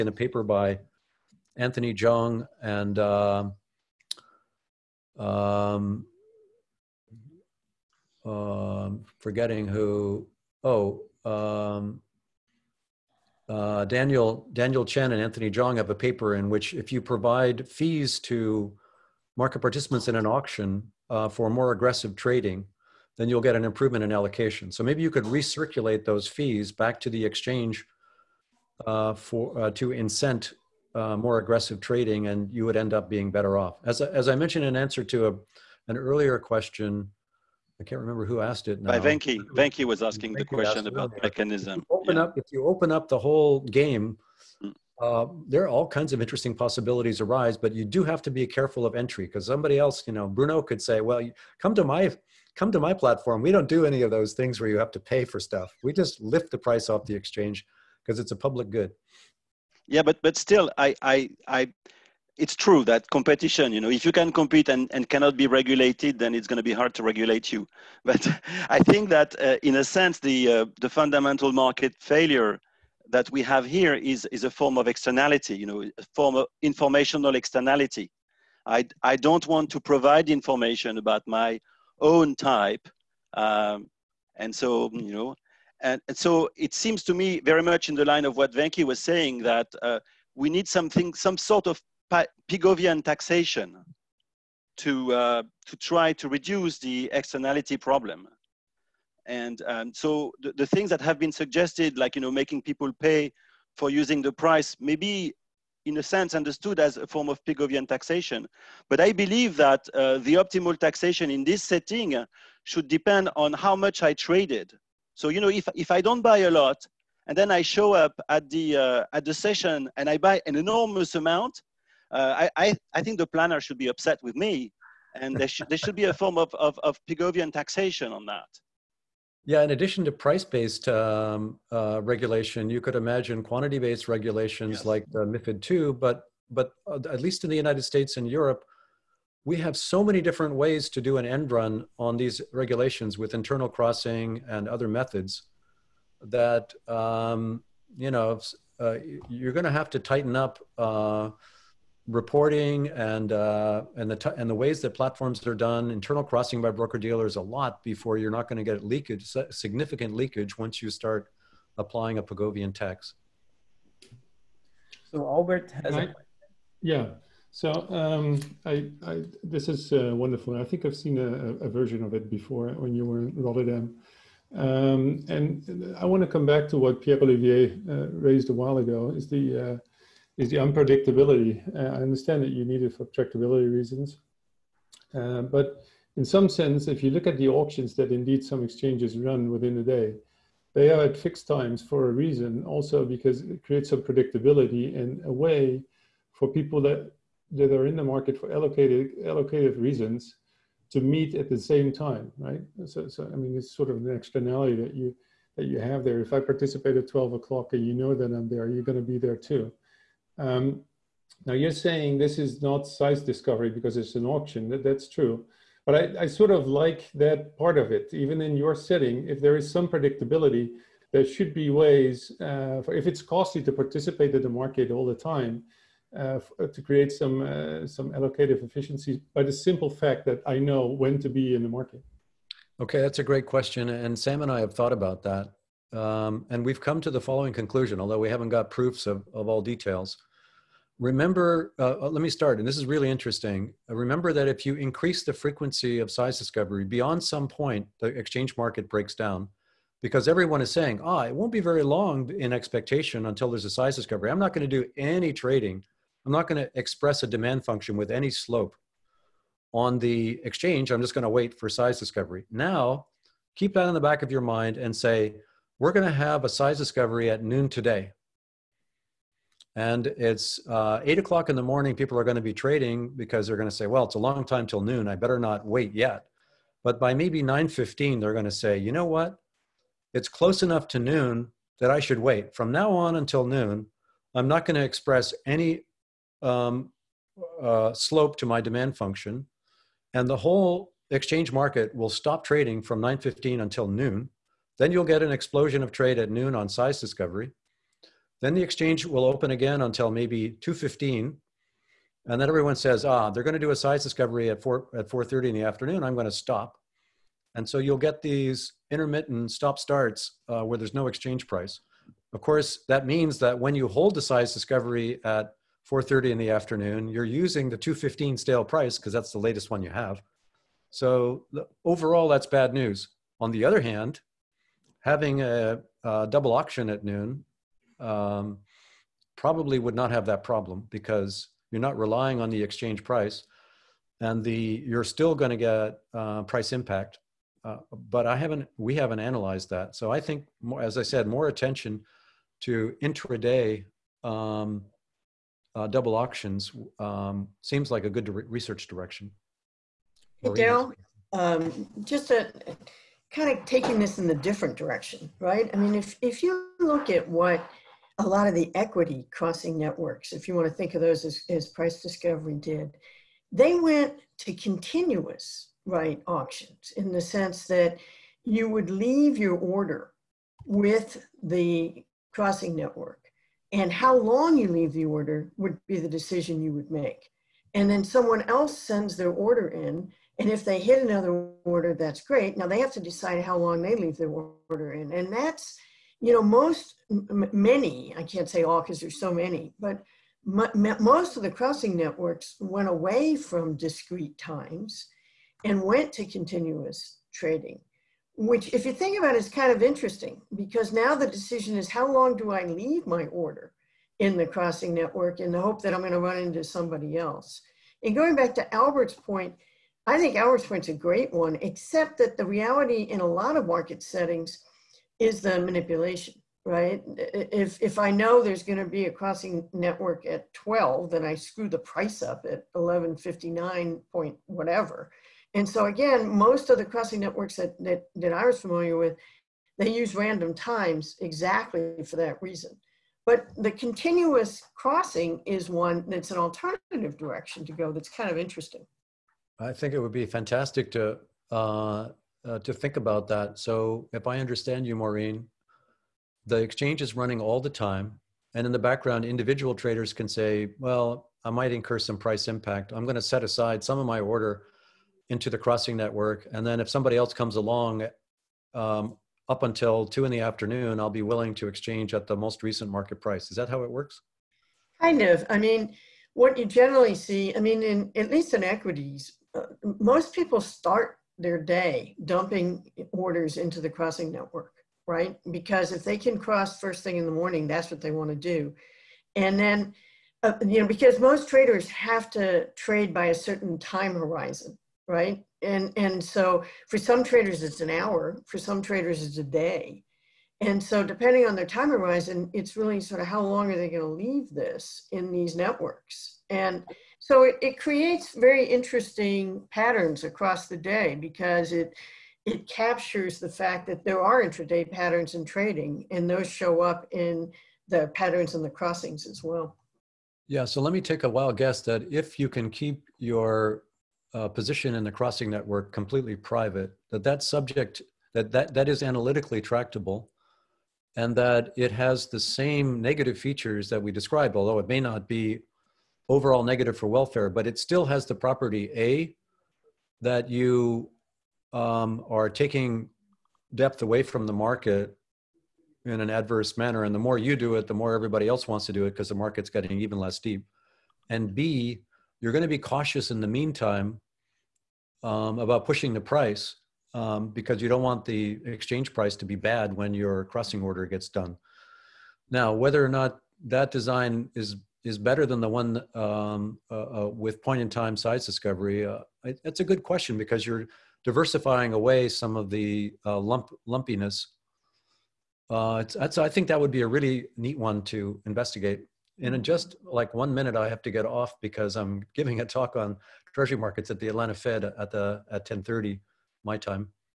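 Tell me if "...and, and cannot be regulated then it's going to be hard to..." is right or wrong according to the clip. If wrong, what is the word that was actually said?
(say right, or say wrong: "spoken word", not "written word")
right.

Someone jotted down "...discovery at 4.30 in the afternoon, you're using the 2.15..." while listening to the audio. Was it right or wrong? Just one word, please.
right.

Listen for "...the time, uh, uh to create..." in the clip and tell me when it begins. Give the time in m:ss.
3:45.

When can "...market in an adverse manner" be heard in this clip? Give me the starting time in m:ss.
8:54.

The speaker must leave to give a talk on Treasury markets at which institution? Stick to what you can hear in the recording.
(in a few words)
Atlanta Fed.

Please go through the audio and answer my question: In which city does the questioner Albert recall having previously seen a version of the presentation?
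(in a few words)
Rotterdam.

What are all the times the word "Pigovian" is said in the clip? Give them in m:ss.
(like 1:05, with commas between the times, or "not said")
1:32, 1:47, 2:07, 2:42.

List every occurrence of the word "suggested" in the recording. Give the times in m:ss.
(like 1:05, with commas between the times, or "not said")
1:41.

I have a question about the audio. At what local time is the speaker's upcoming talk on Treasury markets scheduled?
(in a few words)
10:30.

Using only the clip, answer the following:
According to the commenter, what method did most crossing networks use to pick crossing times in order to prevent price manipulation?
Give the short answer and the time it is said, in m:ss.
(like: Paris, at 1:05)
random times, at 7:10.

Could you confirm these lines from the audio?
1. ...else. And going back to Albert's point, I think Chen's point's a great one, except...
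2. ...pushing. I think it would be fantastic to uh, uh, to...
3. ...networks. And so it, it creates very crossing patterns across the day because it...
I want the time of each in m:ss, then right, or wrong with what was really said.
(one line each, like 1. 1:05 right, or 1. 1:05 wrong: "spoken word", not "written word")
1. 6:47 wrong: "Albert", not "Chen"
2. 7:18 wrong: "interesting", not "pushing"
3. 8:15 wrong: "interesting", not "crossing".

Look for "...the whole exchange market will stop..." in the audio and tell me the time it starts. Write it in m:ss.
4:50.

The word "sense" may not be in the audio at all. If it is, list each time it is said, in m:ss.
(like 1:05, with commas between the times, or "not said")
1:09, 1:46, 3:06, 6:07.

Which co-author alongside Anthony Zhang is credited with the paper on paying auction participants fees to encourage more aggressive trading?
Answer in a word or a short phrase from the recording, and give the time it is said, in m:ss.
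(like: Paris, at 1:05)
Daniel Chen, at 0:13.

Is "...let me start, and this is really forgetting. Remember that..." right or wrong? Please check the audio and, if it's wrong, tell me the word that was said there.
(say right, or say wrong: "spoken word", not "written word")
wrong: "interesting", not "forgetting".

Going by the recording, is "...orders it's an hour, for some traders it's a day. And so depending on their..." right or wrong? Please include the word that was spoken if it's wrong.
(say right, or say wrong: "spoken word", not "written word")
wrong: "traders", not "orders".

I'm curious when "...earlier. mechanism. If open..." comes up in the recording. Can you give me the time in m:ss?
0:41.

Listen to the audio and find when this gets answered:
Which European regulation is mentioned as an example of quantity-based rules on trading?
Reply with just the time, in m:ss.
2:15.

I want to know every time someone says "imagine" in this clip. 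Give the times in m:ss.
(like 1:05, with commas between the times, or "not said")
2:12.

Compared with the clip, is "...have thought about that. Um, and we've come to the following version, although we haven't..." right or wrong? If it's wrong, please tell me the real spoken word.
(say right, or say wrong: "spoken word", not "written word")
wrong: "conclusion", not "version".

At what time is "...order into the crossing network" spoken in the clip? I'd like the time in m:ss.
7:34.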